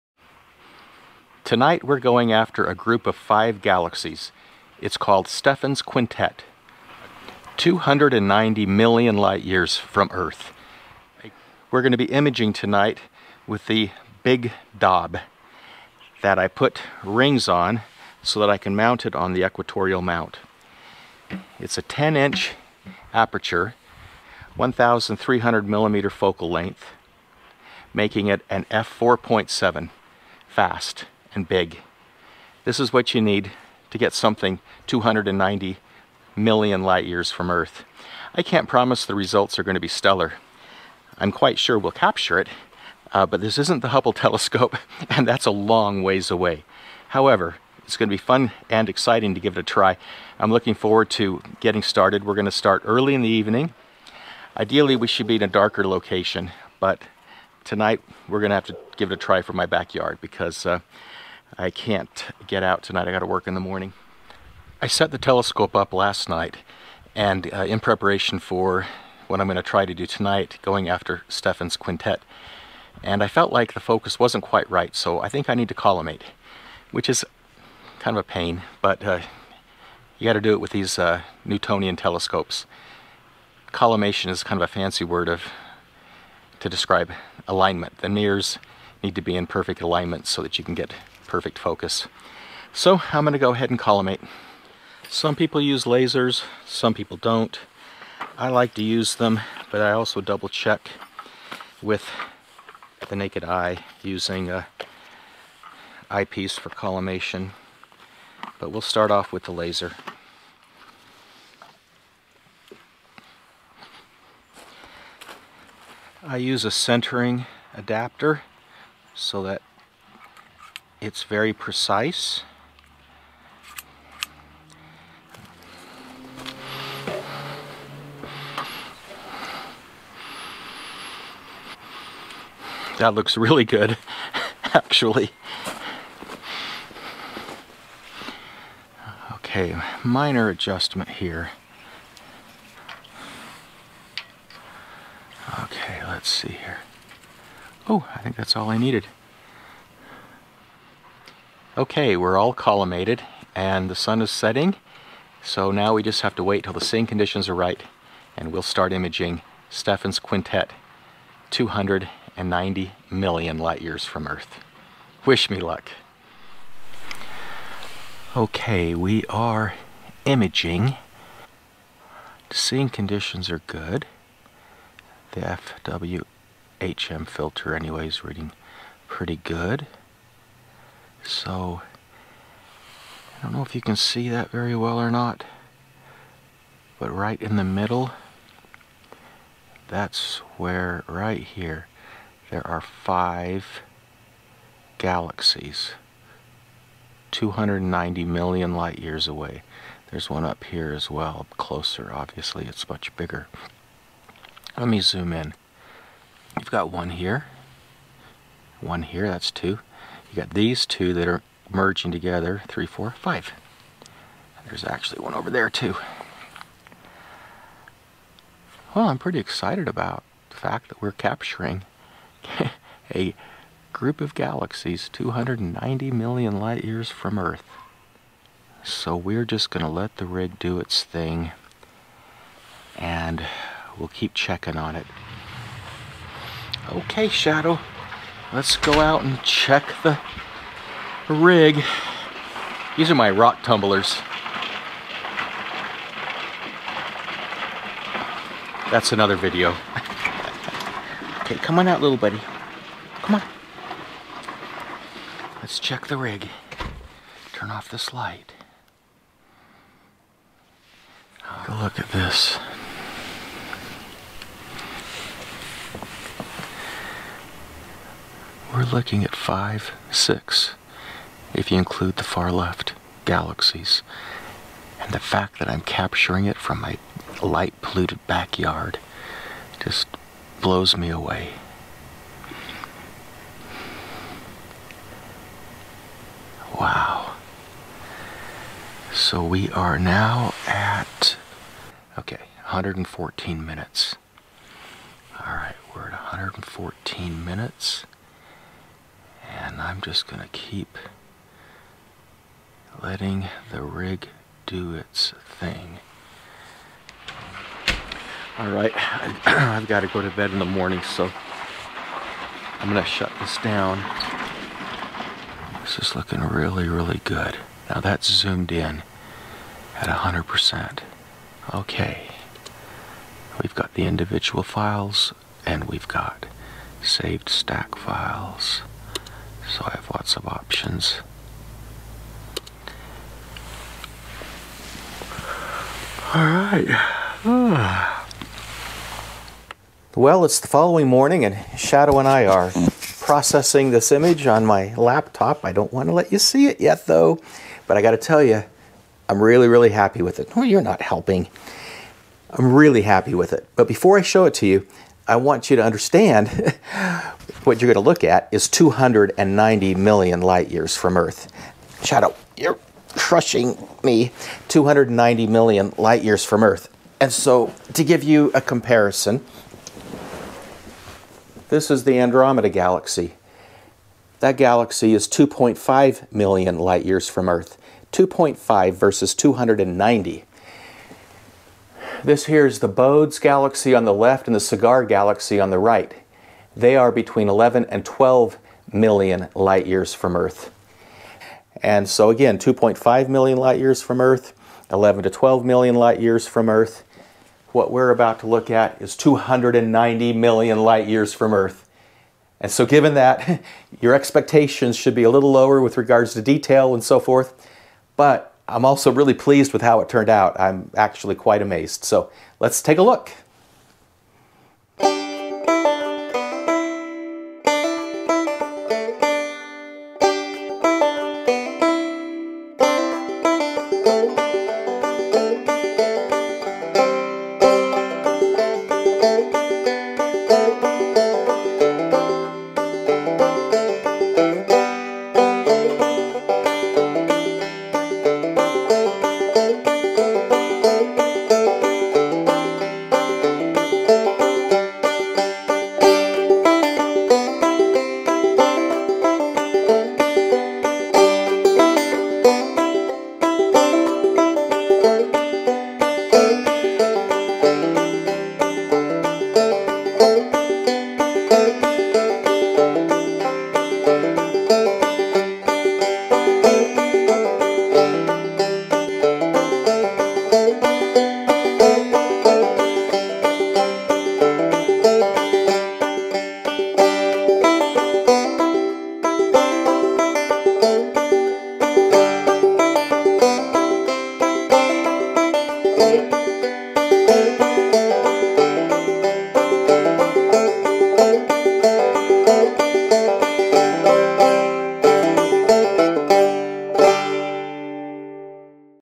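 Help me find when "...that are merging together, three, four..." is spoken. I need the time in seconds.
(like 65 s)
211 s.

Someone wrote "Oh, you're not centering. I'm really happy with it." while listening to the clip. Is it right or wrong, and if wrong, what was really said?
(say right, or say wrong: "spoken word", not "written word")
wrong: "helping", not "centering".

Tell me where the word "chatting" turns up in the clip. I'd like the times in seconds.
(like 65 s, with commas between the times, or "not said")
not said.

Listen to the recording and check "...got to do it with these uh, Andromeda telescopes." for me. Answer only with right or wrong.
wrong.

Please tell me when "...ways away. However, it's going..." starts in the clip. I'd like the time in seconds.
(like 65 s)
46 s.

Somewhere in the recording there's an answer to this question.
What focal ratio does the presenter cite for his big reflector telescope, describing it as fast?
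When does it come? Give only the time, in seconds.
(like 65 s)
28 s.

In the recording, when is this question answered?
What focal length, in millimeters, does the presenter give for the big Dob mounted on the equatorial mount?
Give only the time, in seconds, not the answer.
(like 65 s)
24 s.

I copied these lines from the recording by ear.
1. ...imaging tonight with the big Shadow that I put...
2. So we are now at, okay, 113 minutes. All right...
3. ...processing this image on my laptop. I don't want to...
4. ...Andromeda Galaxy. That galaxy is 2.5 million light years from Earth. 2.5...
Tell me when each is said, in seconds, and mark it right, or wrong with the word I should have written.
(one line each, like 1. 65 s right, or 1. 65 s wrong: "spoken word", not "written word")
1. 12 s wrong: "Dob", not "Shadow"
2. 289 s wrong: "114", not "113"
3. 343 s right
4. 372 s right.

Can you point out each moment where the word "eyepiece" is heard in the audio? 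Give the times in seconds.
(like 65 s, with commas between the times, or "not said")
106 s.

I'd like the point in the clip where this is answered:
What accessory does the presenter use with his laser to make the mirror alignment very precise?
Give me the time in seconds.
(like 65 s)
116 s.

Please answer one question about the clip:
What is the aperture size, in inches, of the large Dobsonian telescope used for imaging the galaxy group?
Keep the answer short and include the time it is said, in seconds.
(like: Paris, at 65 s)
10 inch, at 21 s.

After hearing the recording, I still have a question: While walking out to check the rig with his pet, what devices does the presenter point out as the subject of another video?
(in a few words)
Rock tumblers.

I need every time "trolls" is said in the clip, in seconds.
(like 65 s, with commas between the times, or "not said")
not said.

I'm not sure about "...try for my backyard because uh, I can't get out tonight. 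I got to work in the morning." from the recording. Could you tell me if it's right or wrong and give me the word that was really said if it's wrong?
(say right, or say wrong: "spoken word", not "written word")
right.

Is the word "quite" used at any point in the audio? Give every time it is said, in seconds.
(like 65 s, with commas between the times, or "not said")
41 s, 74 s, 411 s.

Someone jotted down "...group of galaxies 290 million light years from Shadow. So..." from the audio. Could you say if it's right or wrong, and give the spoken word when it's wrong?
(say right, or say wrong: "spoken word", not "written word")
wrong: "Earth", not "Shadow".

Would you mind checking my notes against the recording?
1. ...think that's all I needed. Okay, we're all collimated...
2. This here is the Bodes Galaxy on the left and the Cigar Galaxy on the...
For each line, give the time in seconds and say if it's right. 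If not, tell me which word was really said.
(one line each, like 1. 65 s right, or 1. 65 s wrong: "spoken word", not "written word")
1. 148 s right
2. 382 s right.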